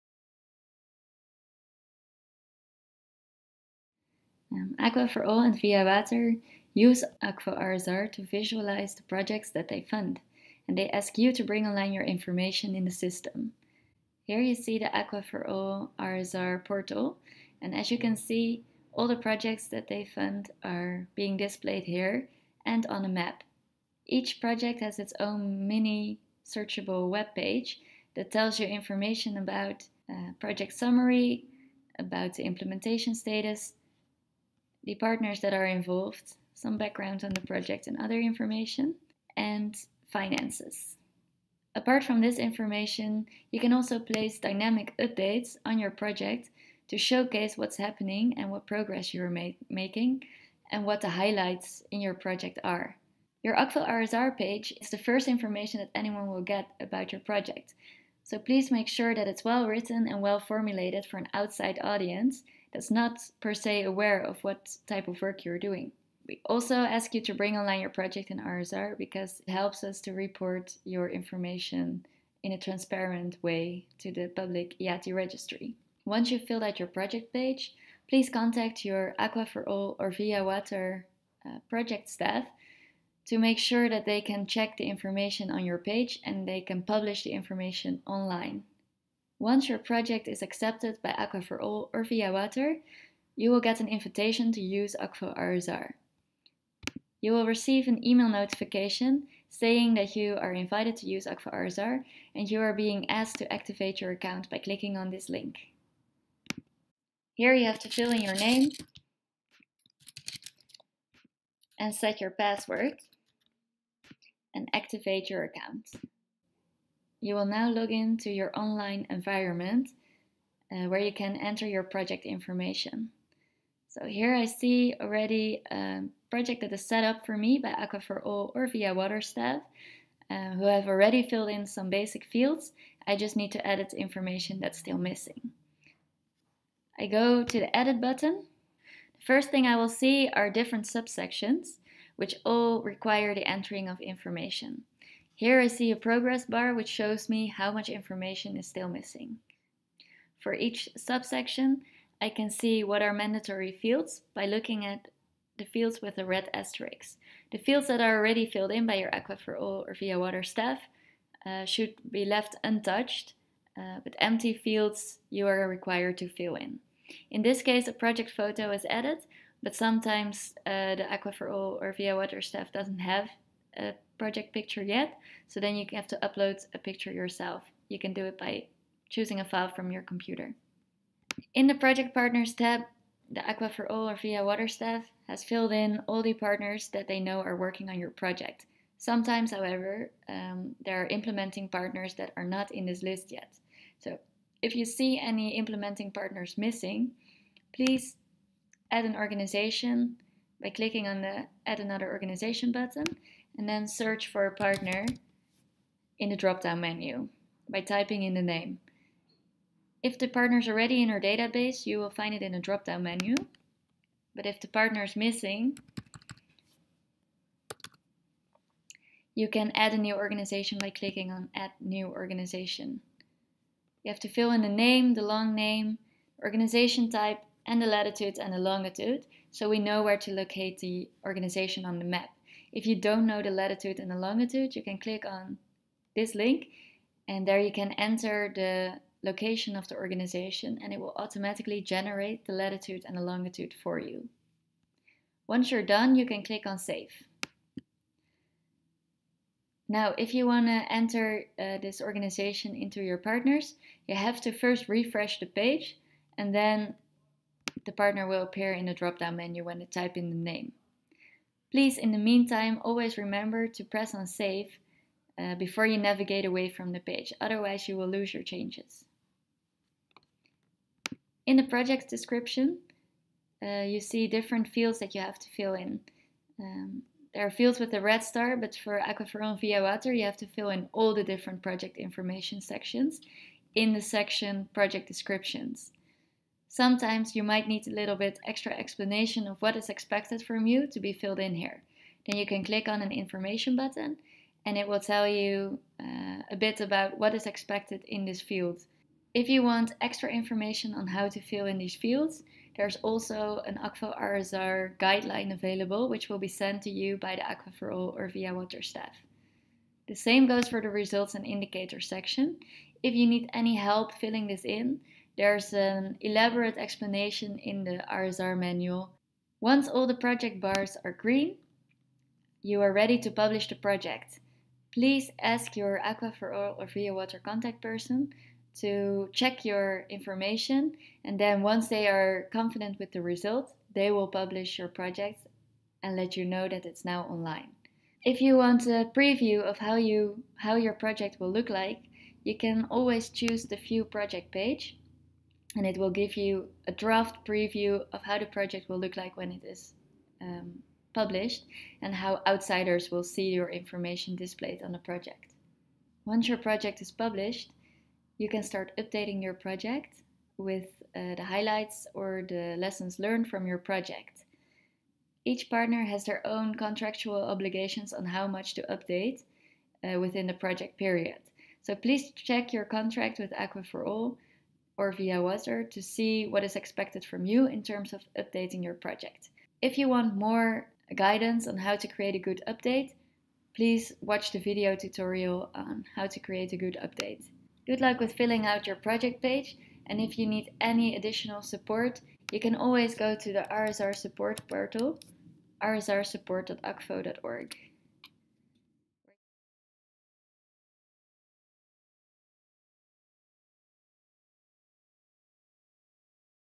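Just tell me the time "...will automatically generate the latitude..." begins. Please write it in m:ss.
4:00.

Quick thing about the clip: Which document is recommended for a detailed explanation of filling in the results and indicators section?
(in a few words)
RSR manual.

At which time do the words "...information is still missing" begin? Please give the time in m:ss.
2:27.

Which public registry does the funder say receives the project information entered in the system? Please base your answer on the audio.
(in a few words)
IATI registry.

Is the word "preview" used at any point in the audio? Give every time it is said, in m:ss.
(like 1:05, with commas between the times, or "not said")
5:39, 5:47.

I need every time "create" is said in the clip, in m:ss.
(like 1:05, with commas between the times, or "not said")
6:22, 6:26.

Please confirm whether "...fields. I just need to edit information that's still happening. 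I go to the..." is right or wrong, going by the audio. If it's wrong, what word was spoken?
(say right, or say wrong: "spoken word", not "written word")
wrong: "missing", not "happening".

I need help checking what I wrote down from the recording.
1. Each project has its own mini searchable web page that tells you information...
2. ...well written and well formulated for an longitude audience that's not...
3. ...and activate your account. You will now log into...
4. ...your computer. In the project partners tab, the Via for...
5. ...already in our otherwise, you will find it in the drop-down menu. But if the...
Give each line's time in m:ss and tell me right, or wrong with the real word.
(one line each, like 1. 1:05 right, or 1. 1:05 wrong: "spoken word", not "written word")
1. 0:24 right
2. 0:59 wrong: "outside", not "longitude"
3. 1:54 right
4. 2:59 wrong: "Aqua", not "Via"
5. 3:30 wrong: "database", not "otherwise".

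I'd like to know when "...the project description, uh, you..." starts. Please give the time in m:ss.
4:31.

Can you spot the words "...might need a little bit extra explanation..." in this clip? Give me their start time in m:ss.
4:47.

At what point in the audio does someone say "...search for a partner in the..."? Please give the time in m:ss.
3:23.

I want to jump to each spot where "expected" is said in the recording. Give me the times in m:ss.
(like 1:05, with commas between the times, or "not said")
4:49, 4:57, 6:16.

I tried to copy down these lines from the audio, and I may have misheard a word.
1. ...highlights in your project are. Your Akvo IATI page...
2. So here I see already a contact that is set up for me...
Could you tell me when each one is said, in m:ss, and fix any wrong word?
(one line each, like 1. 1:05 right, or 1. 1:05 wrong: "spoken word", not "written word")
1. 0:51 wrong: "RSR", not "IATI"
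2. 2:03 wrong: "project", not "contact".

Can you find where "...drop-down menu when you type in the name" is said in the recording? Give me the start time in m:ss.
4:18.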